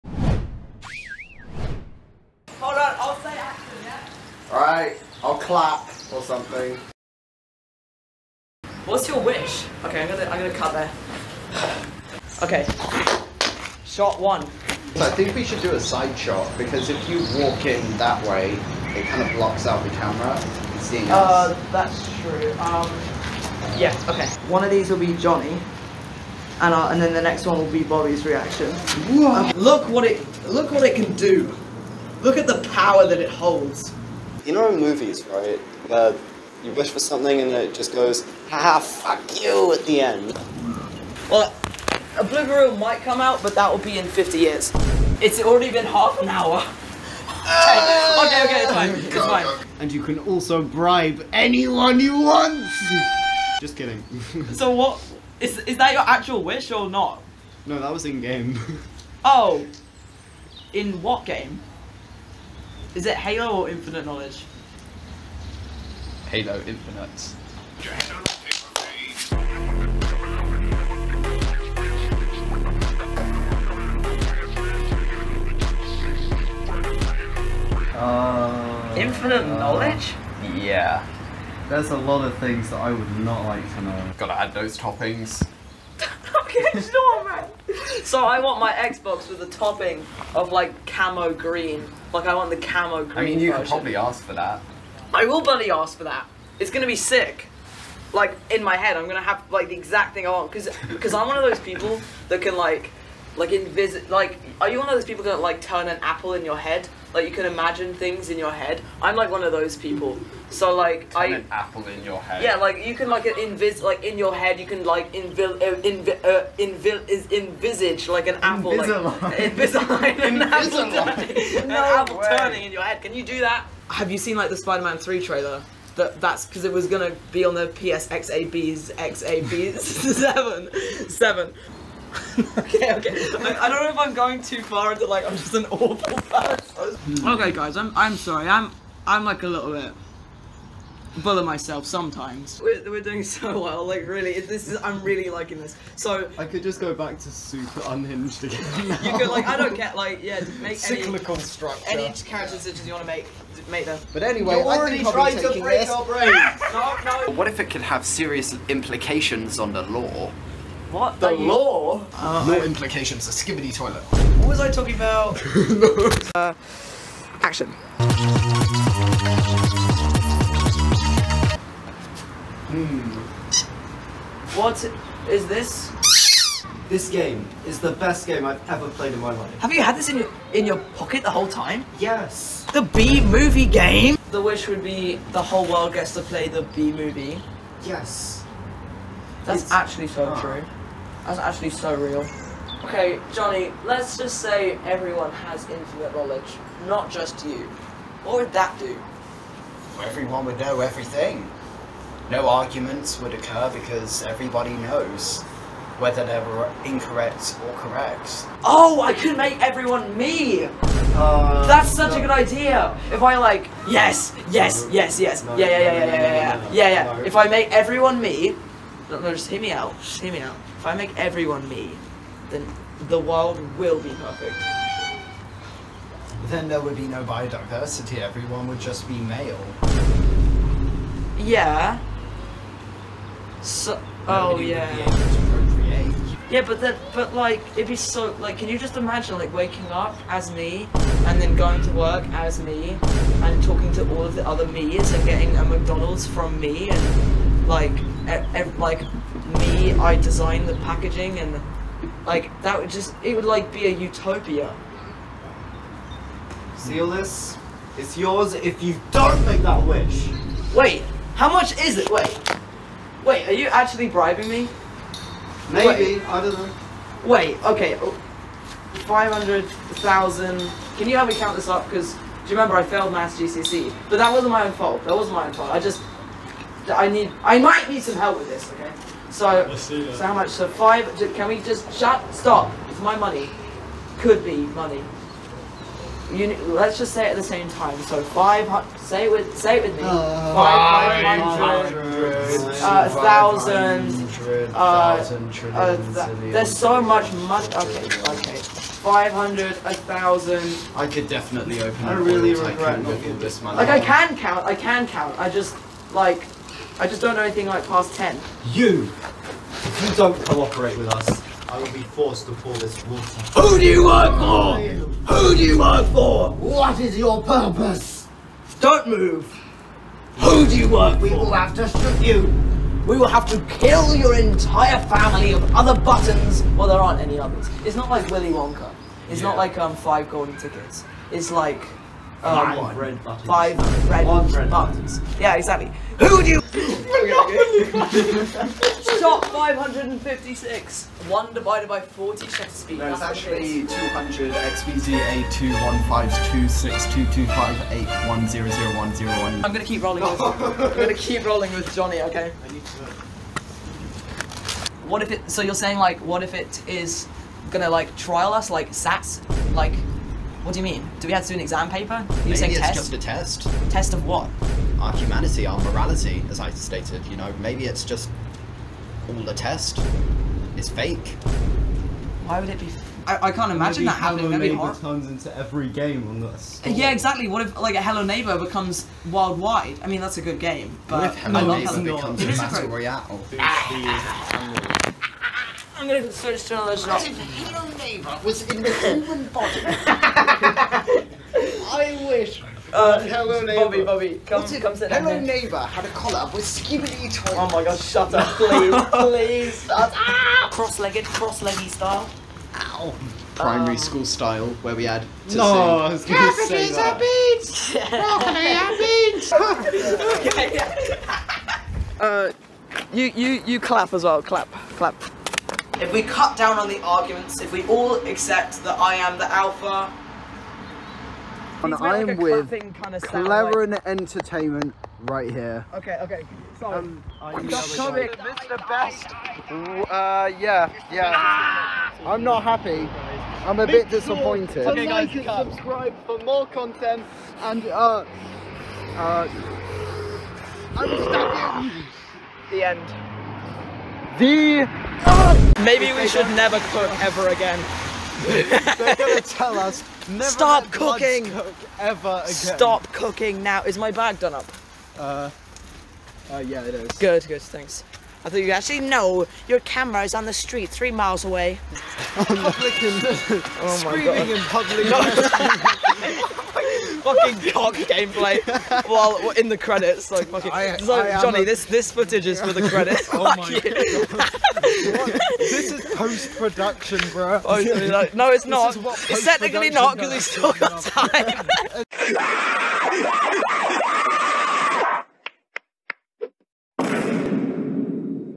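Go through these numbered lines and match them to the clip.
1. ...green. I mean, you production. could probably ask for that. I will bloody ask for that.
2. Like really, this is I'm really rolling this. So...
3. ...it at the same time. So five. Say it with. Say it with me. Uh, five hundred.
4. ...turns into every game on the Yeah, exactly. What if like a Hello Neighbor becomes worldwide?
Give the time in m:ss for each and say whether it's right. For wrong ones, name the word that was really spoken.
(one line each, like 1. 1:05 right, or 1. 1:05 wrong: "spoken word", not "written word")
1. 1:33 wrong: "version", not "production"
2. 2:23 wrong: "liking", not "rolling"
3. 4:47 right
4. 6:15 right.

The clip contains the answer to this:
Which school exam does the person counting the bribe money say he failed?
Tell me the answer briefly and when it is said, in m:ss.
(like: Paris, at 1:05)
Maths GCSE, at 4:33.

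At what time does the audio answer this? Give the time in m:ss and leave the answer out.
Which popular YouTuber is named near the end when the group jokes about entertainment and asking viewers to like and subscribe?
7:08.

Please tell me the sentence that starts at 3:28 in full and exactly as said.
Oh, I could make everyone me!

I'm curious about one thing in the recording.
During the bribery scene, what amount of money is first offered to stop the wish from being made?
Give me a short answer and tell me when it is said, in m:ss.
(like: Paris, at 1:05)
500,000, at 4:29.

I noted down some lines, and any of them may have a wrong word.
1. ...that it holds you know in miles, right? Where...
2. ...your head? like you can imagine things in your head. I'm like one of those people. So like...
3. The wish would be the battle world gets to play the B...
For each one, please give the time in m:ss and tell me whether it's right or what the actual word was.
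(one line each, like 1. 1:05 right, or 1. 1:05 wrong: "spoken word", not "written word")
1. 0:33 wrong: "movies", not "miles"
2. 1:46 right
3. 3:04 wrong: "whole", not "battle".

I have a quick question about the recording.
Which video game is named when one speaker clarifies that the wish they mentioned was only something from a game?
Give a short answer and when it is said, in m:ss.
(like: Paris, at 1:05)
Halo Infinite, at 1:06.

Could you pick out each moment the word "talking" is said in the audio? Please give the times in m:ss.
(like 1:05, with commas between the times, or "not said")
2:44, 4:03.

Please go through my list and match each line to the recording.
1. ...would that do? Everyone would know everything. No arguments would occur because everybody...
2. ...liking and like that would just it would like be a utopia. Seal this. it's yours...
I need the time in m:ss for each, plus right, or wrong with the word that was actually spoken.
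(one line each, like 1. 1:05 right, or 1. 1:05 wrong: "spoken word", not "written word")
1. 3:18 right
2. 4:10 wrong: "packaging", not "liking".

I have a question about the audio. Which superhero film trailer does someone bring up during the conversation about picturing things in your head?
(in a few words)
Spider-Man 3.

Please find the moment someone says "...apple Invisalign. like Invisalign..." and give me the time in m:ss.
1:58.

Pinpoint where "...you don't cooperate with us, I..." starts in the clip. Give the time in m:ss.
5:10.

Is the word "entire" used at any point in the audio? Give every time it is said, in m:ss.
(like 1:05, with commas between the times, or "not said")
5:24.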